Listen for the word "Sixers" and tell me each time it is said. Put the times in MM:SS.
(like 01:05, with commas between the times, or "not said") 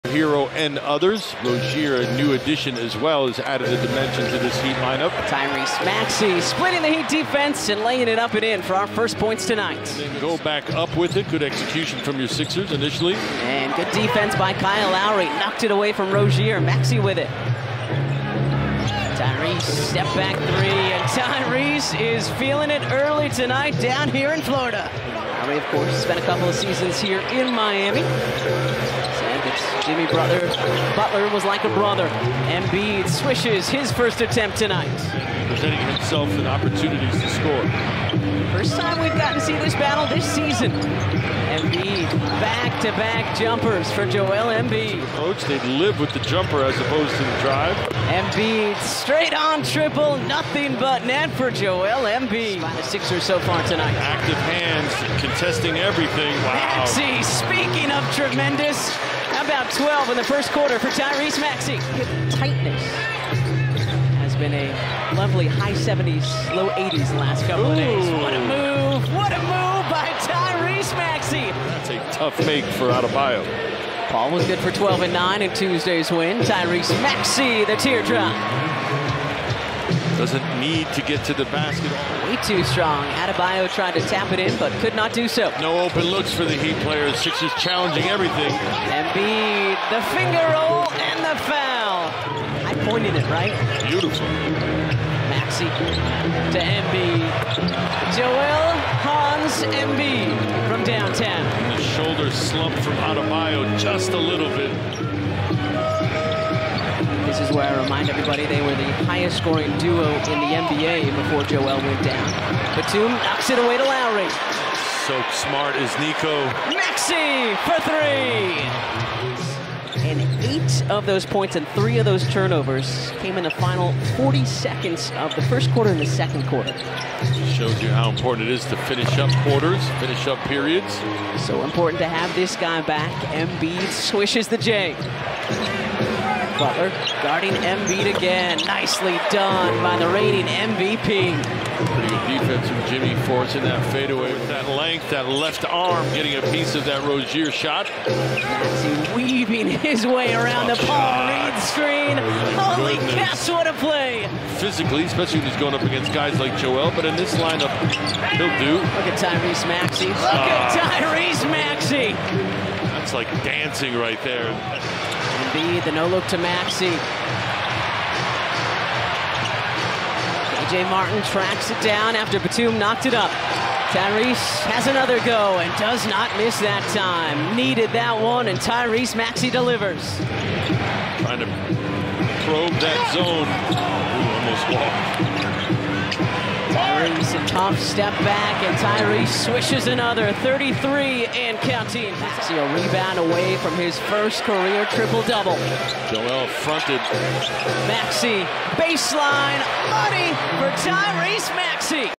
00:12, 00:52, 01:27.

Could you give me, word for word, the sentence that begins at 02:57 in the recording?
Needed that one, and Tyrese Maxey delivers.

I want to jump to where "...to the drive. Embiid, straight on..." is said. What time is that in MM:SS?
00:47.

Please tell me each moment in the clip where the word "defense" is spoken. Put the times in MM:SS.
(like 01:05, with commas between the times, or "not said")
00:07, 00:13, 02:22.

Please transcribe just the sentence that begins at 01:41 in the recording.
And the shoulder slump from Adebayo just a little bit.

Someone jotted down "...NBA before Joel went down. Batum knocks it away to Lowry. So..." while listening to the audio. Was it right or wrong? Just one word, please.
right.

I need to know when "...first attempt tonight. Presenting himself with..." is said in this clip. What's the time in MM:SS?
00:33.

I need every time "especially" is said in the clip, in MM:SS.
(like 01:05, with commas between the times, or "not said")
02:35.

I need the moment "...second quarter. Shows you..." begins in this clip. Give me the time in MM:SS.
02:06.